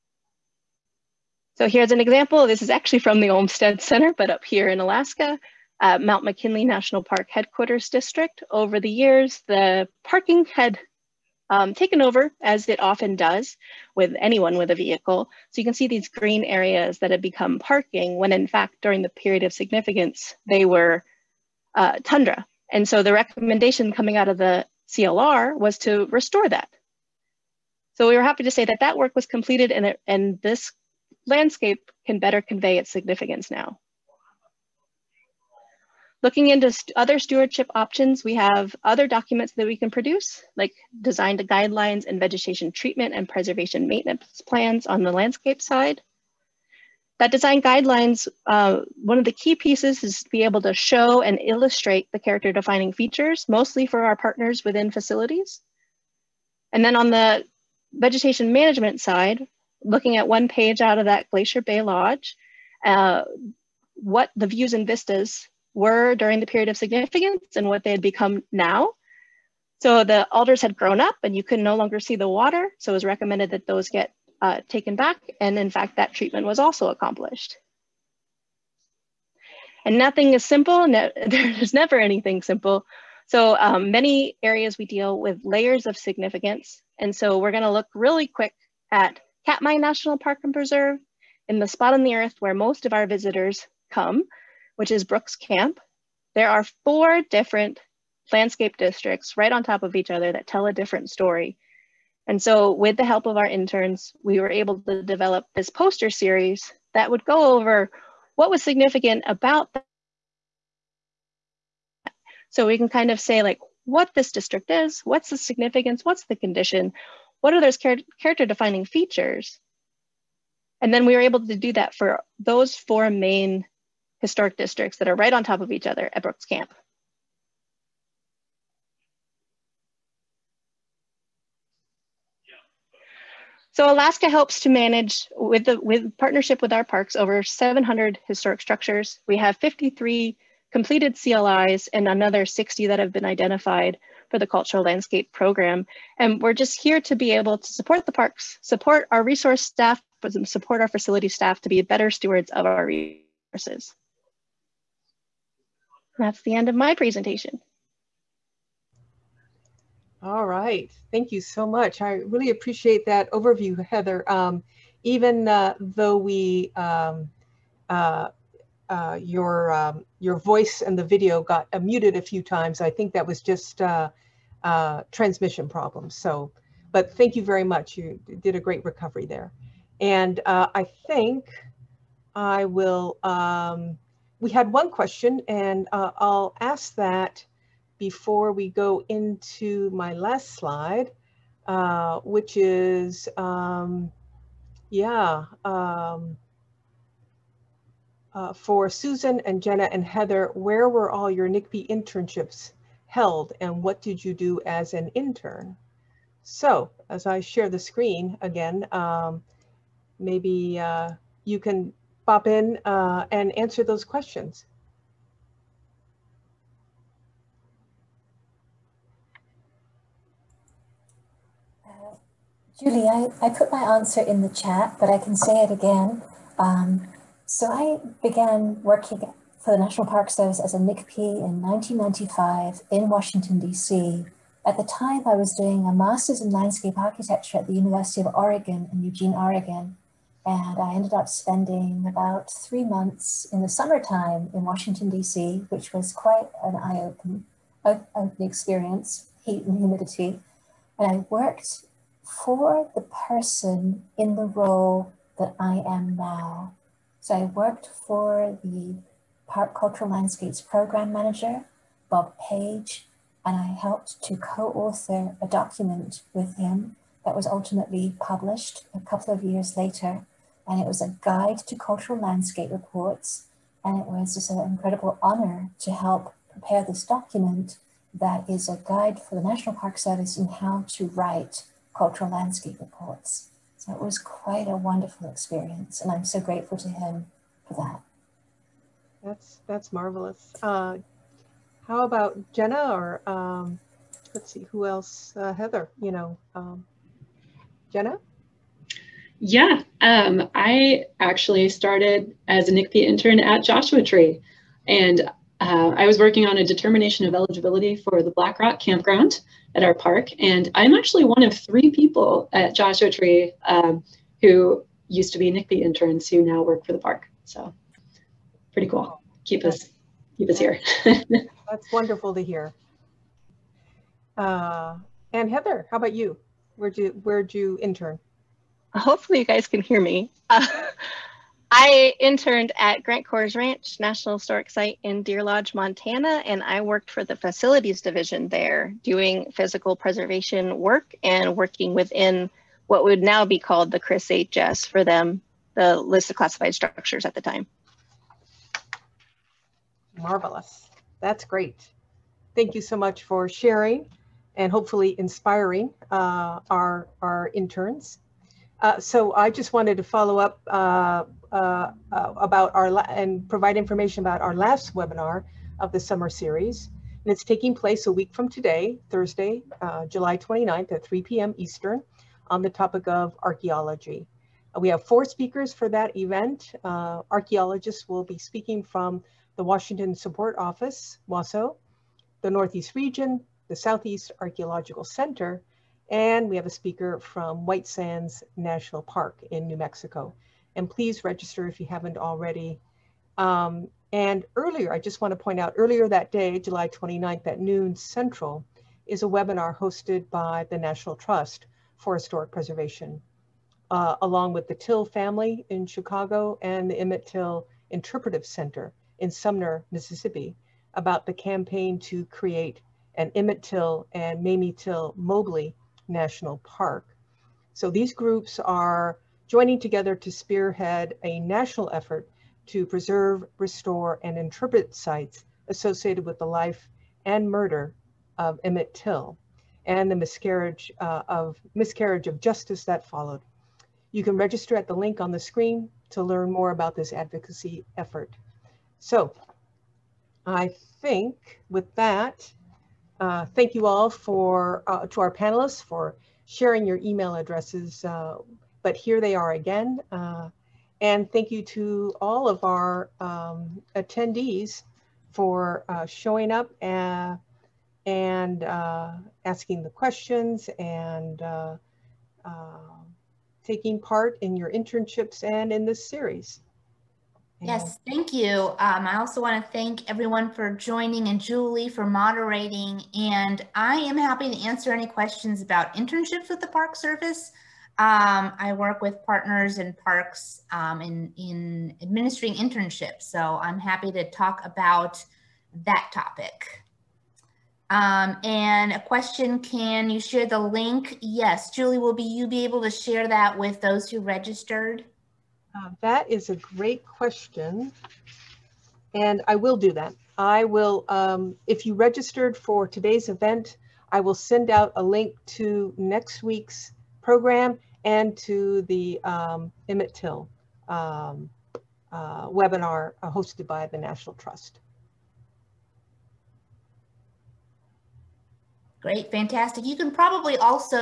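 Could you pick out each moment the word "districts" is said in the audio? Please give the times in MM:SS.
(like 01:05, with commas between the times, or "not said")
00:07, 01:38, 01:54, 02:04.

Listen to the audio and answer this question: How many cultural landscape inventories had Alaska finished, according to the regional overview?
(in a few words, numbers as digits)
53.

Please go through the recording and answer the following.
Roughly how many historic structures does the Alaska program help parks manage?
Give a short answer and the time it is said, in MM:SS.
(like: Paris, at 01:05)
Over 700, at 02:17.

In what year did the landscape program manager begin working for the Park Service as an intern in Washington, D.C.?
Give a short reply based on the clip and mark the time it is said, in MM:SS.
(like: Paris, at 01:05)
1995, at 03:51.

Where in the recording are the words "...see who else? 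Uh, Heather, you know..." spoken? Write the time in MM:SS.
04:54.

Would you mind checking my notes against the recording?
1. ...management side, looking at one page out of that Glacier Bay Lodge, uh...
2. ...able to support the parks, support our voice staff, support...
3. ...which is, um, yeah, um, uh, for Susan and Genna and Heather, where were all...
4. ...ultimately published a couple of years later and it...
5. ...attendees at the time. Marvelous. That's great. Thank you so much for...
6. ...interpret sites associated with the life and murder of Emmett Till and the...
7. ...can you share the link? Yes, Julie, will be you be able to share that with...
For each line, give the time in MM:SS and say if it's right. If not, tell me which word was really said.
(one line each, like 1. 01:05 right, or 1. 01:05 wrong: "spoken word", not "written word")
1. 00:58 right
2. 02:27 wrong: "resource", not "voice"
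3. 03:12 right
4. 04:27 right
5. 05:46 wrong: "structures", not "attendees"
6. 07:04 right
7. 08:09 right.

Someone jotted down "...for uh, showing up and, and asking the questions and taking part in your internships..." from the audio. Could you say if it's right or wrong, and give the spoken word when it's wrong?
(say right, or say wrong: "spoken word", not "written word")
right.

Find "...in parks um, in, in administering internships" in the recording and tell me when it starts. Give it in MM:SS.
07:59.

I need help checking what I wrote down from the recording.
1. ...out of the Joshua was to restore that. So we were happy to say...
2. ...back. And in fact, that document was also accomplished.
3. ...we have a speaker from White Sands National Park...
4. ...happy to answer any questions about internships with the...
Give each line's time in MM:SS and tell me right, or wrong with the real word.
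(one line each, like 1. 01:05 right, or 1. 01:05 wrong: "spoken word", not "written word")
1. 00:24 wrong: "CLR", not "Joshua"
2. 01:14 wrong: "treatment", not "document"
3. 06:26 right
4. 07:54 right.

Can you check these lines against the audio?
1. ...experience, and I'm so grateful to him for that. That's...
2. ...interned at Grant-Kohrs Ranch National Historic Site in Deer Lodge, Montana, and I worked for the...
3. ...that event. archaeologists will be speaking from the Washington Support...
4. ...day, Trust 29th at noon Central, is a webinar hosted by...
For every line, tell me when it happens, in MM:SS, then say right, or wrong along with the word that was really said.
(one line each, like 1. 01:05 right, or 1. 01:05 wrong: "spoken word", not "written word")
1. 04:45 right
2. 05:32 right
3. 06:15 right
4. 06:36 wrong: "July", not "Trust".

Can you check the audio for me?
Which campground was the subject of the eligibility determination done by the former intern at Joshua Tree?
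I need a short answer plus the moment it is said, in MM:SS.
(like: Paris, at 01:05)
Black Rock campground, at 05:08.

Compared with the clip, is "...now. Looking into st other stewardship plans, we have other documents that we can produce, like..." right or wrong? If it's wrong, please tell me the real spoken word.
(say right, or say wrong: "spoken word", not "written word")
wrong: "options", not "plans".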